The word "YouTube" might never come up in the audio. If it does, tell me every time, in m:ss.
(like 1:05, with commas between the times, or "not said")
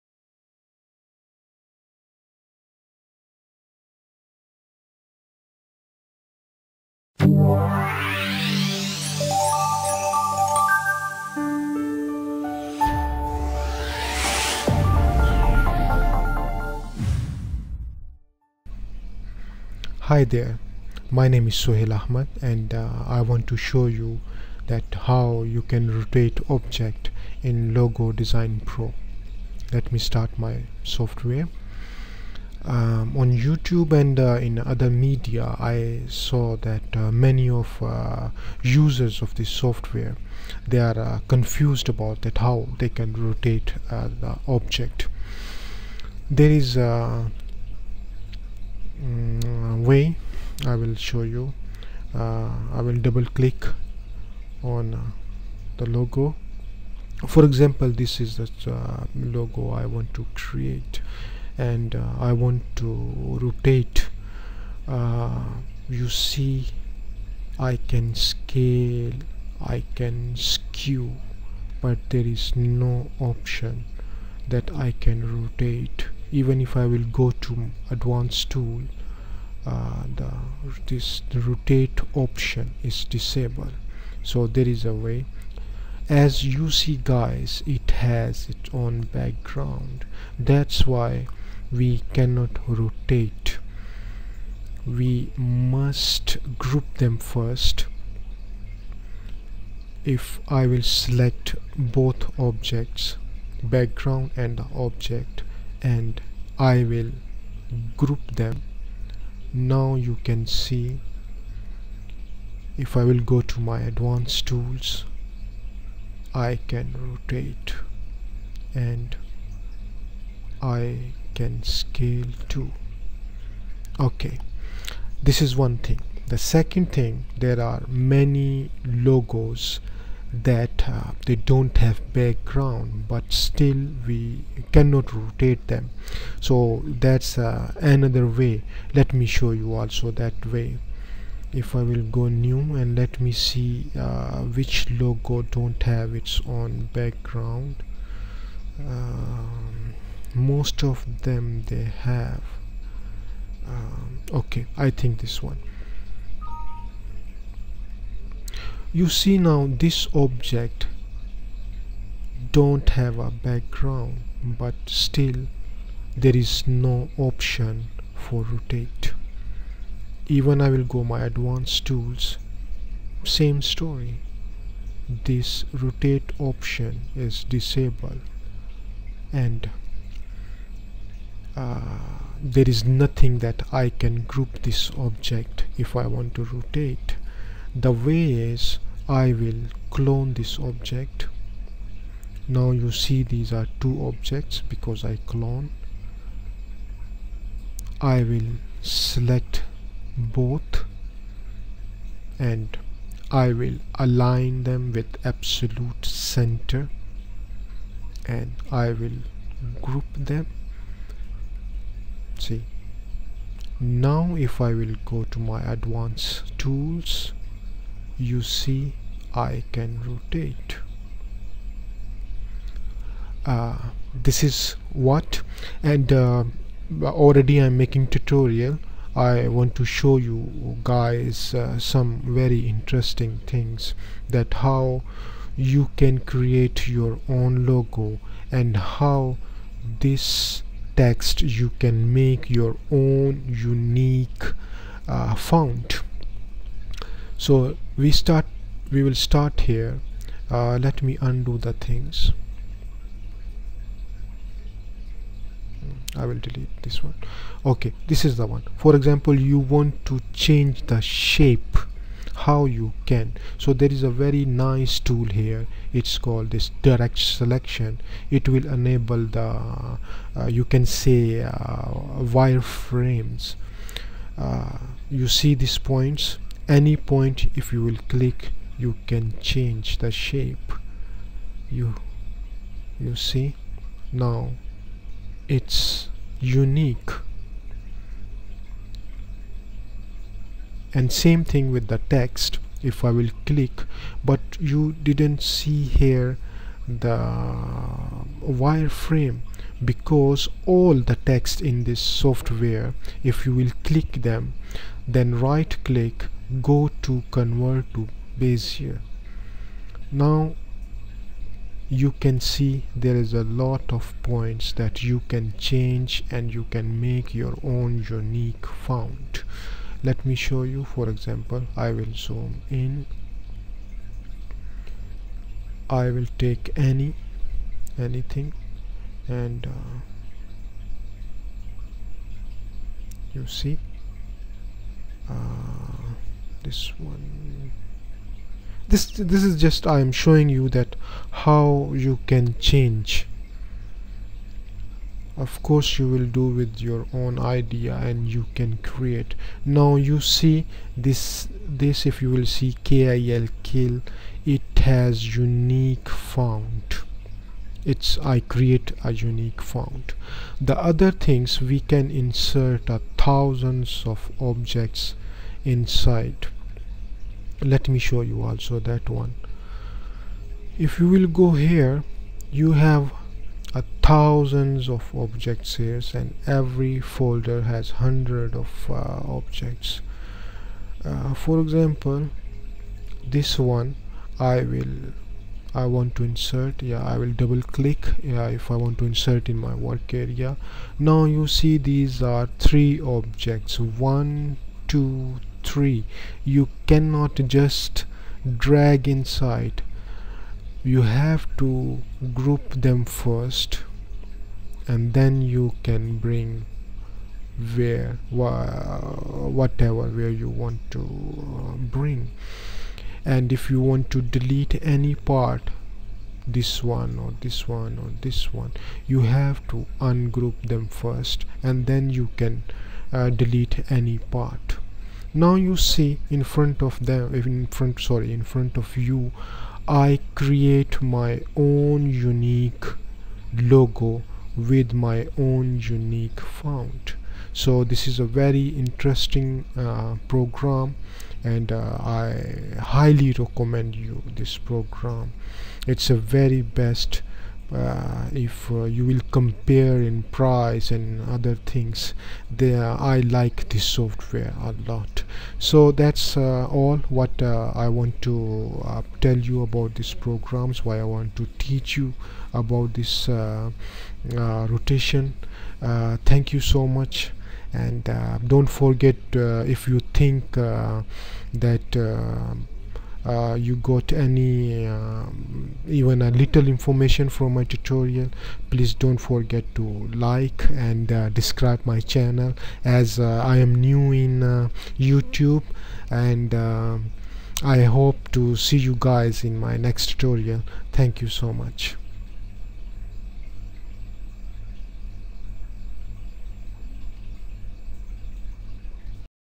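0:33, 8:04.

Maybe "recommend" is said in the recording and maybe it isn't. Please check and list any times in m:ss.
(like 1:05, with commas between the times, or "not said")
7:23.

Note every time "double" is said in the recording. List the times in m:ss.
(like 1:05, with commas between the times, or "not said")
0:52, 6:27.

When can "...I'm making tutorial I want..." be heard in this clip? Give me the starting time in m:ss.
3:47.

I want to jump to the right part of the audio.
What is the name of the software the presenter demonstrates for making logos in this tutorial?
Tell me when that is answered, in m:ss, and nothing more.
0:27.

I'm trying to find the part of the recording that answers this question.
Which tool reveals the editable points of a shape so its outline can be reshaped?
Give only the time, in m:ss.
4:26.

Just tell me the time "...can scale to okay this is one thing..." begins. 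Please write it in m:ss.
2:01.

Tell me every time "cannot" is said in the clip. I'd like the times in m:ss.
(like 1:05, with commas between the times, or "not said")
1:32, 2:14, 6:36.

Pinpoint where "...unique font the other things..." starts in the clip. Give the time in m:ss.
5:59.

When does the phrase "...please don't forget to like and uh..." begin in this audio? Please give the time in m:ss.
7:58.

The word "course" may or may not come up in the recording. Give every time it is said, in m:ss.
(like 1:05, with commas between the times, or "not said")
5:45.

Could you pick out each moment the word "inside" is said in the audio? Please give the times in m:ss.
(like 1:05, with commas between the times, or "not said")
6:05, 6:39.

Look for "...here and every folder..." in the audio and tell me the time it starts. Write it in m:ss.
6:15.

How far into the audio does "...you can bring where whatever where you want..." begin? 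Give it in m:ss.
6:45.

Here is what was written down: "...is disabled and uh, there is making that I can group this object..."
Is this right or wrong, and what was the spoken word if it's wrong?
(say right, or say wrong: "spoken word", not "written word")
wrong: "nothing", not "making".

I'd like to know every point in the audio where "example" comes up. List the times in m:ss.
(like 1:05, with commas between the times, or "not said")
0:57, 4:18, 5:21, 6:21.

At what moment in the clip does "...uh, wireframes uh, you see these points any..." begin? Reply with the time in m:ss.
4:31.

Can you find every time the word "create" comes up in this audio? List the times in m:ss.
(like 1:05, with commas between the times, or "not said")
1:00, 3:56, 5:48, 5:58, 7:10.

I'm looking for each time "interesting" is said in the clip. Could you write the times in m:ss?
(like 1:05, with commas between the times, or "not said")
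3:52, 7:18.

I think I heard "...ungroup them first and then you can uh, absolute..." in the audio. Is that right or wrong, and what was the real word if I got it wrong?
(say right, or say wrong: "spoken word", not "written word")
wrong: "delete", not "absolute".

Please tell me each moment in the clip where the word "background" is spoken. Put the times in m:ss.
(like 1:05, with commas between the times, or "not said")
1:29, 1:43, 2:12, 2:26, 2:43.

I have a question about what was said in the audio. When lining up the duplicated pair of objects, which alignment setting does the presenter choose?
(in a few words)
absolute center.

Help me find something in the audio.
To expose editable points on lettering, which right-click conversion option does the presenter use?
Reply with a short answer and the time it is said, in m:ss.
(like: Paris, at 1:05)
convert to Bezier, at 5:07.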